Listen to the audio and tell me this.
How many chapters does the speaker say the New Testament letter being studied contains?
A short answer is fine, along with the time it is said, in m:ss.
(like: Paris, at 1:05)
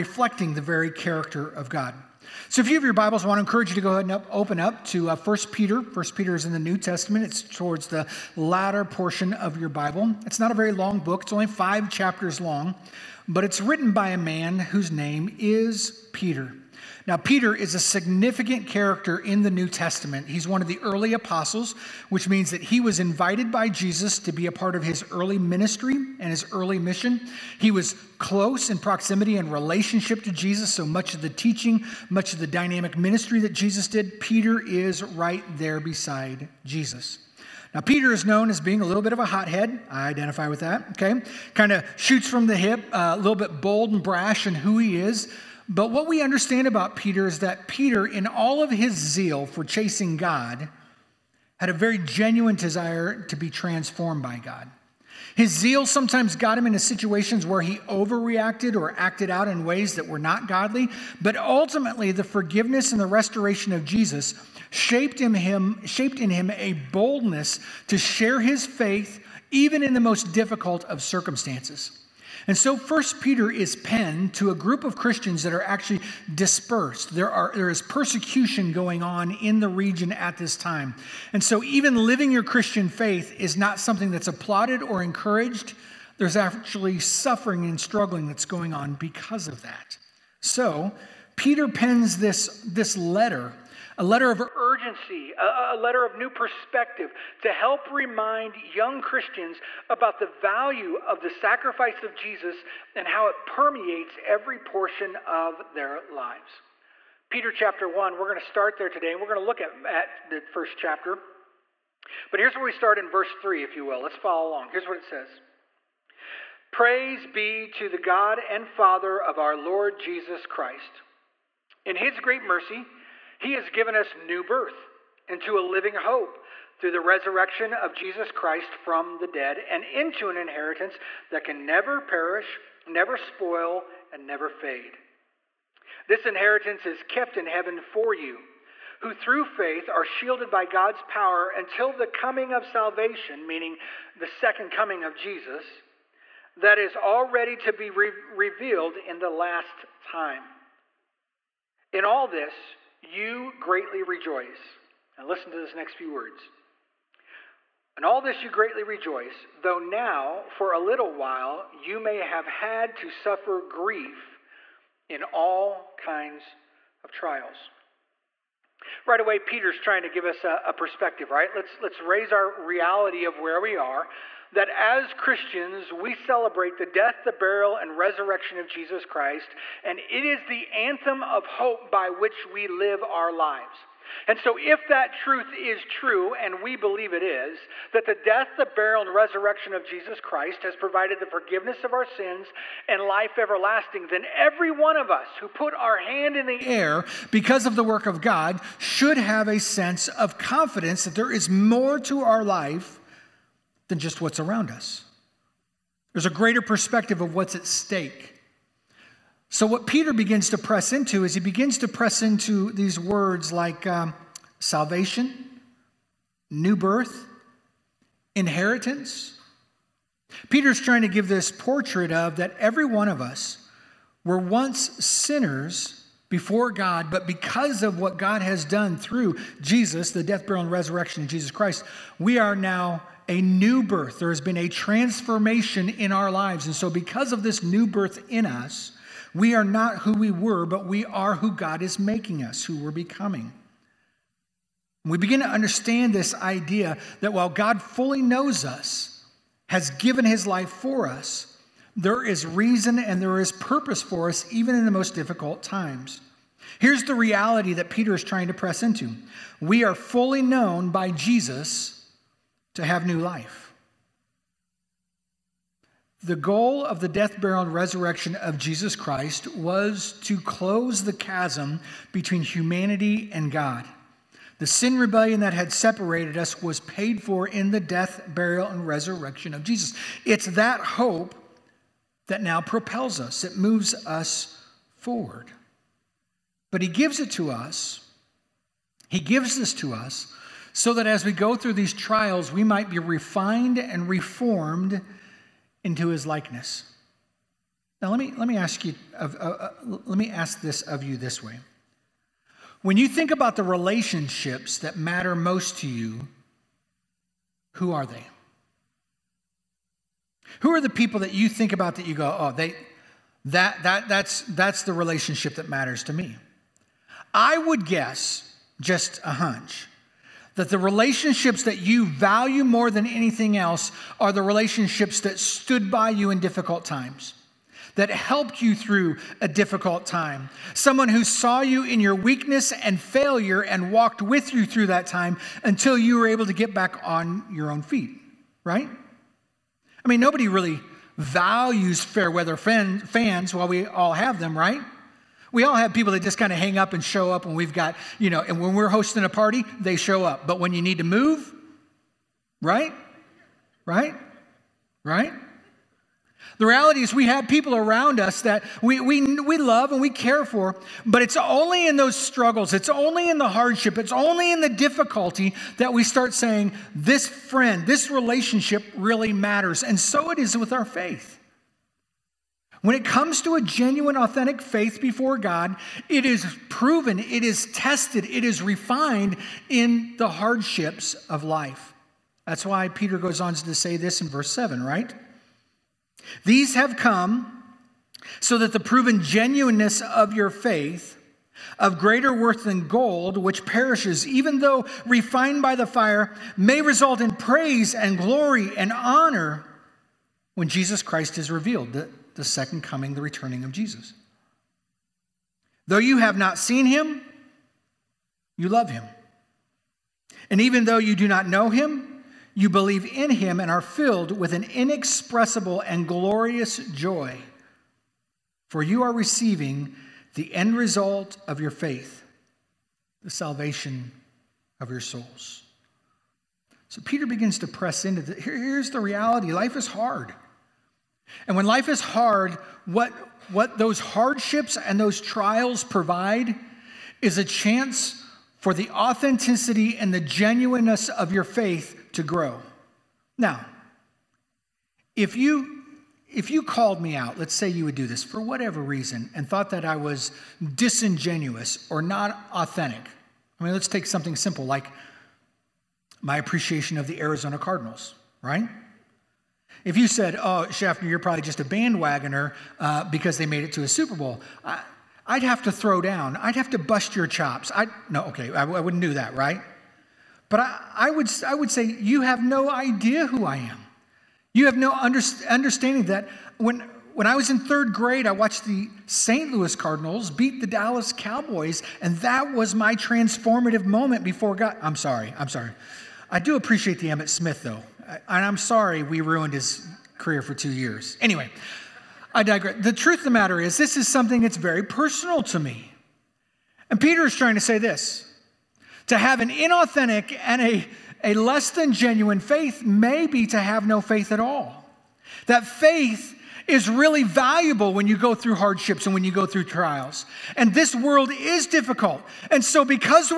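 5, at 0:11.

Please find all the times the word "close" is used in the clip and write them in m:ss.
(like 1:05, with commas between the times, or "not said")
0:28, 4:30.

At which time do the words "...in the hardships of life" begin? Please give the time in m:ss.
6:19.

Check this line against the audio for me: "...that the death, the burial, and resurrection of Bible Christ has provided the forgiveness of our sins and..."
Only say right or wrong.
wrong.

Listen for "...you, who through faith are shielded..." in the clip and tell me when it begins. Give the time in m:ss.
2:18.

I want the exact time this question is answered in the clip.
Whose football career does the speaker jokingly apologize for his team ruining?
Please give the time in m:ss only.
8:07.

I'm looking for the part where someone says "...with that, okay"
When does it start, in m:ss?
0:40.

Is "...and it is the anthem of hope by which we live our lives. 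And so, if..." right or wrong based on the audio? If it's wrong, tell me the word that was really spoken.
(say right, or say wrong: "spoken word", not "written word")
right.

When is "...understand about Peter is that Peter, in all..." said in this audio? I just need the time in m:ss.
0:46.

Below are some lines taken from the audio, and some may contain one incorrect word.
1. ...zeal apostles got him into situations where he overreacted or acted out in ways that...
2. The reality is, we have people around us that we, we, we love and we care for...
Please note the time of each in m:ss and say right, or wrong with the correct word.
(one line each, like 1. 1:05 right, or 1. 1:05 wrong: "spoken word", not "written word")
1. 0:55 wrong: "sometimes", not "apostles"
2. 5:56 right.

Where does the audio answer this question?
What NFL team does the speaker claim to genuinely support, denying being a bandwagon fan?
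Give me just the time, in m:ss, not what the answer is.
7:37.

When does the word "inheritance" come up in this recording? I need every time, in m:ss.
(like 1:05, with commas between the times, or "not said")
2:10, 2:16, 3:38.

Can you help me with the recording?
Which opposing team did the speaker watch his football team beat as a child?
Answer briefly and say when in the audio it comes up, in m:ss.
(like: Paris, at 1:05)
Dallas Cowboys, at 8:00.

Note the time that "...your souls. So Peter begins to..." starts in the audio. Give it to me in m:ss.
7:04.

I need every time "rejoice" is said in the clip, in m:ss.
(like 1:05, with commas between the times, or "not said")
2:34, 2:38.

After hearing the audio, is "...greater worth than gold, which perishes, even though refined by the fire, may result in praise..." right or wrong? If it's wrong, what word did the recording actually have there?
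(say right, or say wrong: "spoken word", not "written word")
right.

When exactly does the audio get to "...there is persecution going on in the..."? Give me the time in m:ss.
1:17.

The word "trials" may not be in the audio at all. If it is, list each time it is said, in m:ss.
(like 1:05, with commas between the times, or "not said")
2:47, 4:51, 7:15, 8:29.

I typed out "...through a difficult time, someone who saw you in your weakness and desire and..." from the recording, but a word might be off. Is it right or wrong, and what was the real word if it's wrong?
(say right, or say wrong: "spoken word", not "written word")
wrong: "failure", not "desire".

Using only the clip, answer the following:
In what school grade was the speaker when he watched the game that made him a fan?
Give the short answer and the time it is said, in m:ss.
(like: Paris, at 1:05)
third grade, at 7:57.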